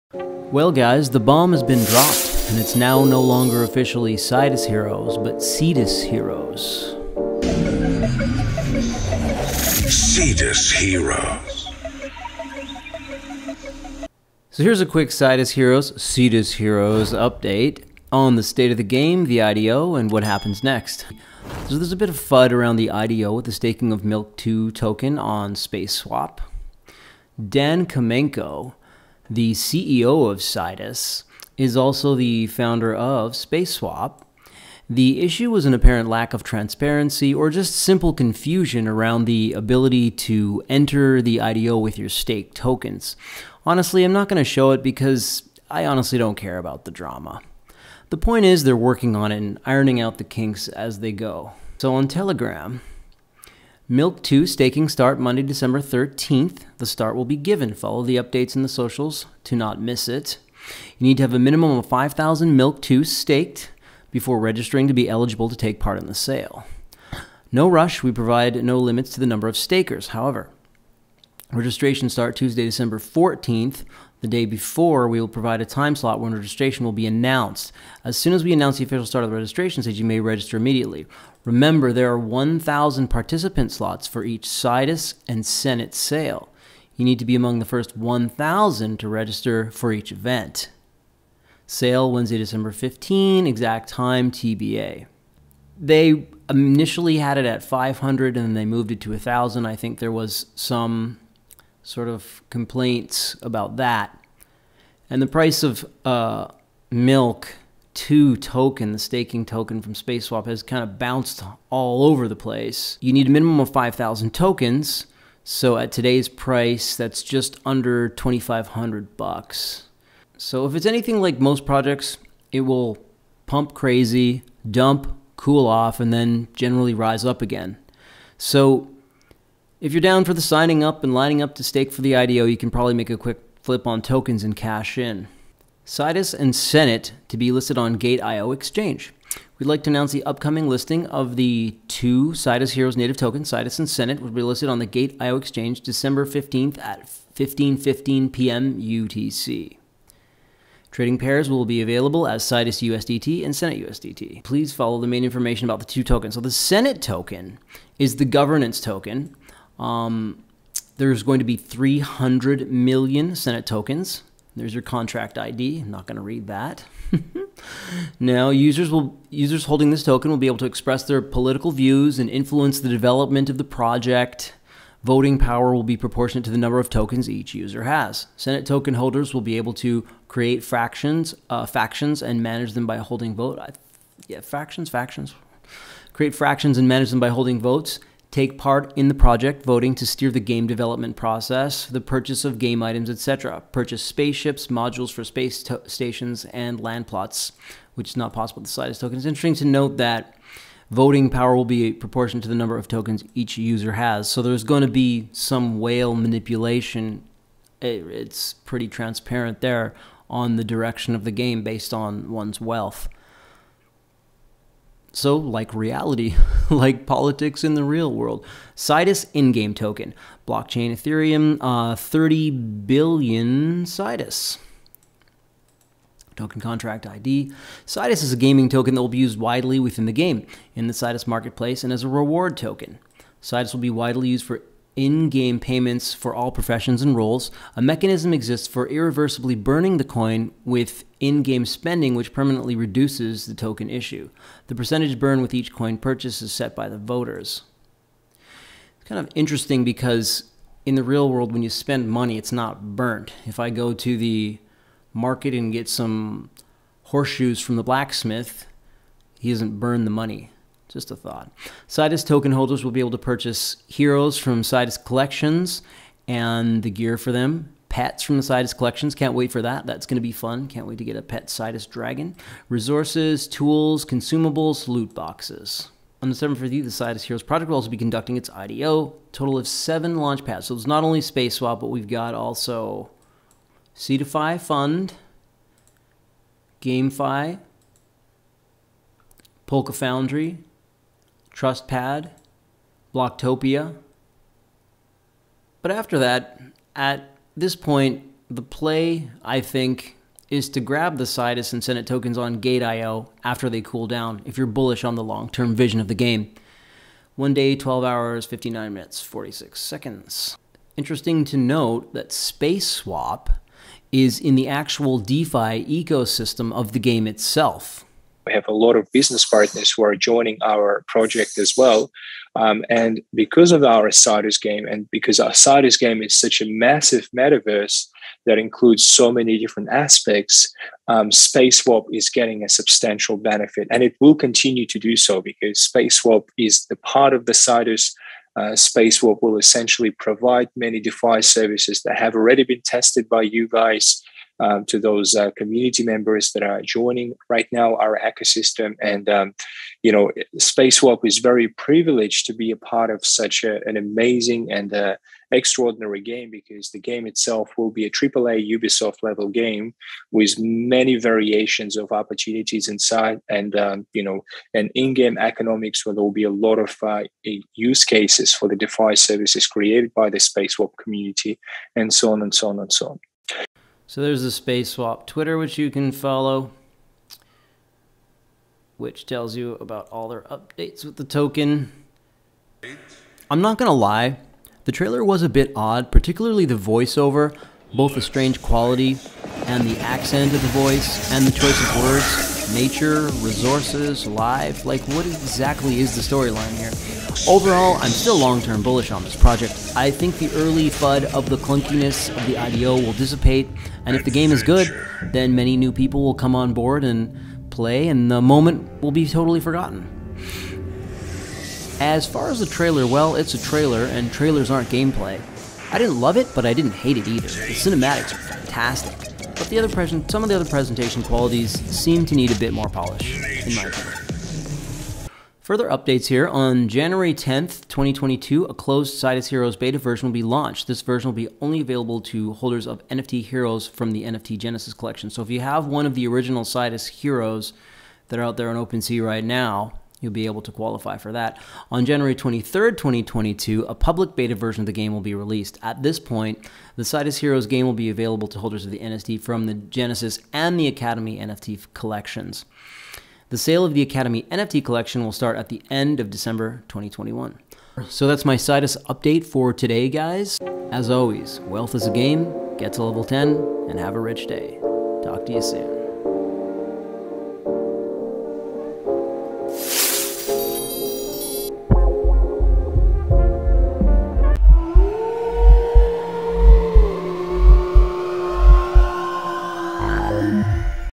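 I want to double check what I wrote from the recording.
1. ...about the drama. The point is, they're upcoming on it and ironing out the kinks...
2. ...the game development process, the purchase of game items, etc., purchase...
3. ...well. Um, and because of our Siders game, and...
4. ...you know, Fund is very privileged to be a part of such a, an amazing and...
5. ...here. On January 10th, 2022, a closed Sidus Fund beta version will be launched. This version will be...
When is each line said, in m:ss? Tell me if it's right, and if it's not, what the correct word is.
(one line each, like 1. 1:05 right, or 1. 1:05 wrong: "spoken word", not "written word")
1. 0:46 wrong: "working", not "upcoming"
2. 3:10 right
3. 5:21 right
4. 5:50 wrong: "SpaceSwap", not "Fund"
5. 7:06 wrong: "Heroes", not "Fund".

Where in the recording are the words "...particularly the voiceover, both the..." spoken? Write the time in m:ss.
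6:26.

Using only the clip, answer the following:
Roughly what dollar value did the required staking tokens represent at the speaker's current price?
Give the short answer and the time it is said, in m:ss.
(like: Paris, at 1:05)
just under $2,500, at 1:57.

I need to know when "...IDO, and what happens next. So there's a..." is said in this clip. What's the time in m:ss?
0:19.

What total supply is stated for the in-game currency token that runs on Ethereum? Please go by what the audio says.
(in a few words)
30 billion.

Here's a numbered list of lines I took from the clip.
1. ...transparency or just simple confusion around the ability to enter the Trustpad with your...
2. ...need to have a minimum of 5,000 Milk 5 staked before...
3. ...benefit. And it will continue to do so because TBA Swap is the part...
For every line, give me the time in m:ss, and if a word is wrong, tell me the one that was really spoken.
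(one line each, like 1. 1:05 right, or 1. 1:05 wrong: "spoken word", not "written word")
1. 0:36 wrong: "IDO", not "Trustpad"
2. 1:01 wrong: "2", not "5"
3. 5:33 wrong: "Space", not "TBA".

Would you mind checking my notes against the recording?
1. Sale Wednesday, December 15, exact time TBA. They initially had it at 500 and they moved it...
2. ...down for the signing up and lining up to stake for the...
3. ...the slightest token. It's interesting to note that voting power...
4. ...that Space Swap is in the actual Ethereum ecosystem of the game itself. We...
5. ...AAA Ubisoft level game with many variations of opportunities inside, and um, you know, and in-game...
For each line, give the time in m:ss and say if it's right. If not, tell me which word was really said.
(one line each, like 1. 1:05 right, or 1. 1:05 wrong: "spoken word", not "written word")
1. 1:31 right
2. 2:10 right
3. 3:18 right
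4. 5:12 wrong: "DeFi", not "Ethereum"
5. 5:58 right.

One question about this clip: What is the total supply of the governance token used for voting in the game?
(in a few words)
300 million.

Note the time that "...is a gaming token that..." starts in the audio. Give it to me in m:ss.
3:48.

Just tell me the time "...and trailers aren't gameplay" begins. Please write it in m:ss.
6:54.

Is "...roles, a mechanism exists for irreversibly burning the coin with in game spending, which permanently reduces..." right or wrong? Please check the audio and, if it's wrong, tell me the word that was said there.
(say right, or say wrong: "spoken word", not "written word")
right.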